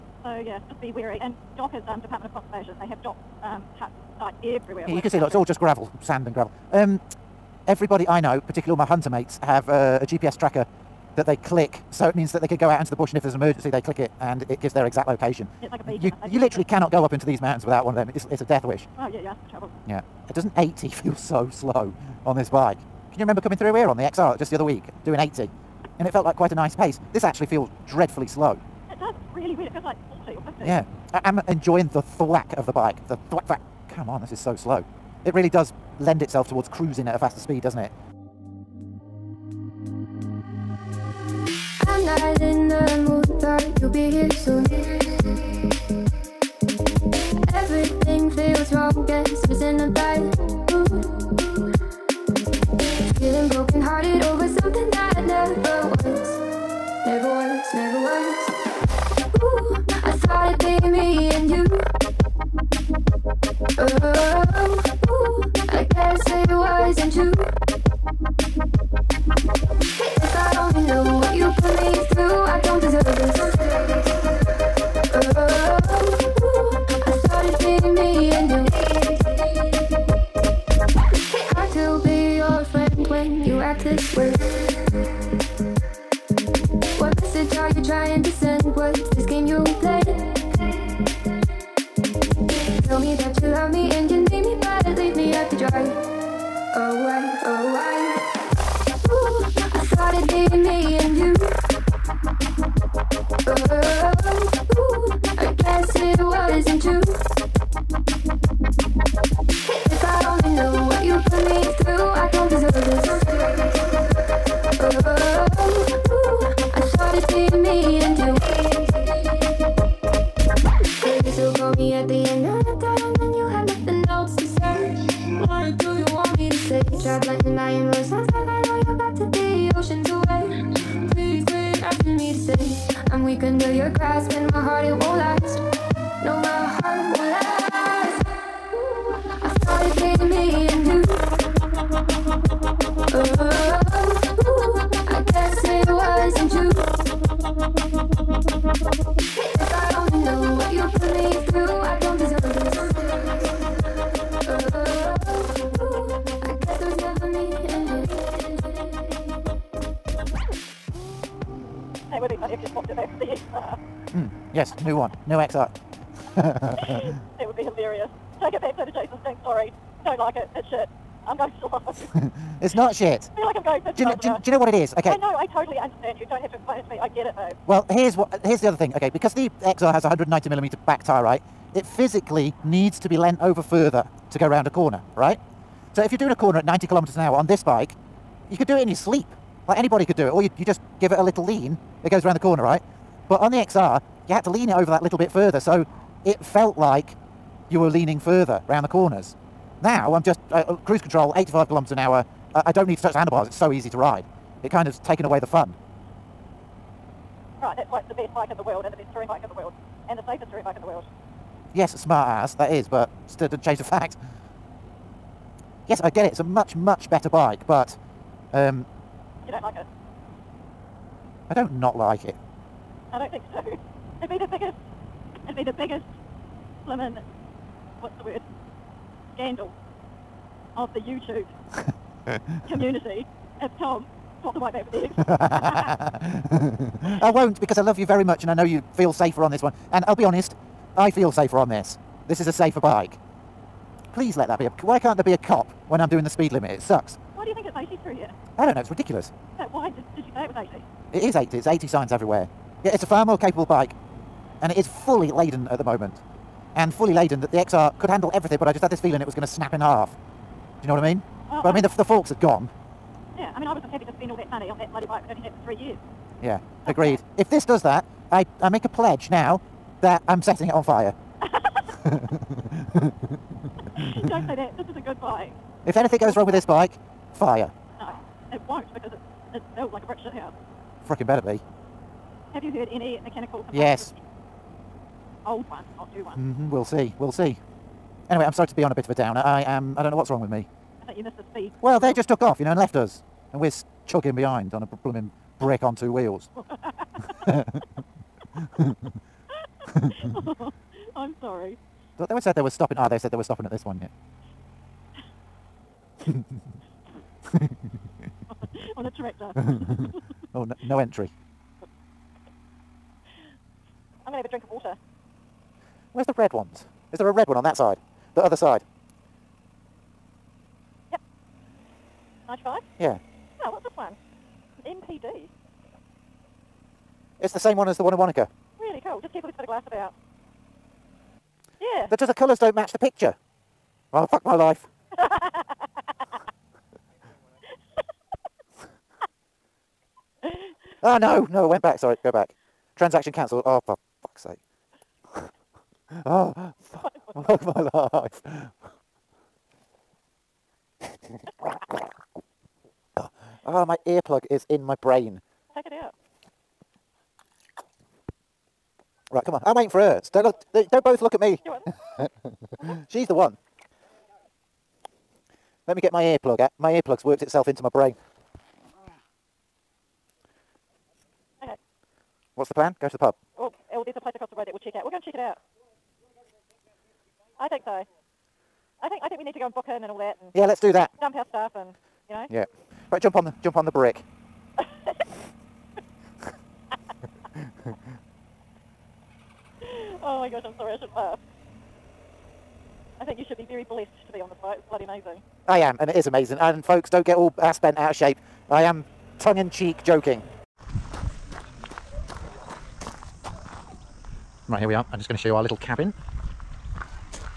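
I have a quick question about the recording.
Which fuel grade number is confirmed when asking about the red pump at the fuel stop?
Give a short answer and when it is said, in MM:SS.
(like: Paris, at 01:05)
95, at 05:22.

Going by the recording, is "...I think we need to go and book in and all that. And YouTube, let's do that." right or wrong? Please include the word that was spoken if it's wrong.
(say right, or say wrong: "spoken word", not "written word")
wrong: "Yeah", not "YouTube".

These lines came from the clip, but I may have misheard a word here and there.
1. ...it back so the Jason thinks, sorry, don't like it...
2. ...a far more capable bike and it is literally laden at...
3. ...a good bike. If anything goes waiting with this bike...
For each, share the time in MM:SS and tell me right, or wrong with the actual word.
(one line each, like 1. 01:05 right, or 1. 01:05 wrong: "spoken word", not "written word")
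1. 02:48 right
2. 04:13 wrong: "fully", not "literally"
3. 04:34 wrong: "wrong", not "waiting".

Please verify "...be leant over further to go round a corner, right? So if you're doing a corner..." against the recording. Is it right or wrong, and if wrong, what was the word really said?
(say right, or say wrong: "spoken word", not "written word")
right.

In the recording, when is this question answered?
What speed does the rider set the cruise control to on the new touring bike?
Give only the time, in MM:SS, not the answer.
03:21.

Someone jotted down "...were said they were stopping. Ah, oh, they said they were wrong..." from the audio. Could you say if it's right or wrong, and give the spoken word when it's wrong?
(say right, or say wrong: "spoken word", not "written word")
wrong: "stopping", not "wrong".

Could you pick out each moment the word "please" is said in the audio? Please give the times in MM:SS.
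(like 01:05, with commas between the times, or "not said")
04:04.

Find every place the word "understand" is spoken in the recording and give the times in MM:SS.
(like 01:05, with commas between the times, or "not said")
02:55.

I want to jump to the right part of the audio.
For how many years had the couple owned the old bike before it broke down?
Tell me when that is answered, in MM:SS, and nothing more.
04:25.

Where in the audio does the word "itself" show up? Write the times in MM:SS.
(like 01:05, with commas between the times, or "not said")
00:36, 06:07.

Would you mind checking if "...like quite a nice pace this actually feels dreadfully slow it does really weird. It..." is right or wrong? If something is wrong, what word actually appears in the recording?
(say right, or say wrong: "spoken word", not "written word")
right.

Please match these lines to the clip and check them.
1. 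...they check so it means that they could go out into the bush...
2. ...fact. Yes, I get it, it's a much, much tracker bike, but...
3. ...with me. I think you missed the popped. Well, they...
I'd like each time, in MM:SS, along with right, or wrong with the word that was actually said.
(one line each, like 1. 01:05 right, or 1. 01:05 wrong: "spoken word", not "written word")
1. 00:11 wrong: "click", not "check"
2. 03:33 wrong: "better", not "tracker"
3. 04:50 wrong: "speed", not "popped".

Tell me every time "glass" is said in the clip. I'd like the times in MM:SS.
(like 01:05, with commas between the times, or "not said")
05:29.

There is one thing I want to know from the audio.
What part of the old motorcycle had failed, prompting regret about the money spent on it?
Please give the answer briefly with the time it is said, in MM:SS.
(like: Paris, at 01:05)
The forks, at 04:21.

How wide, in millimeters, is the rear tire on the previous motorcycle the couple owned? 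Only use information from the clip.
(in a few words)
190 millimeters.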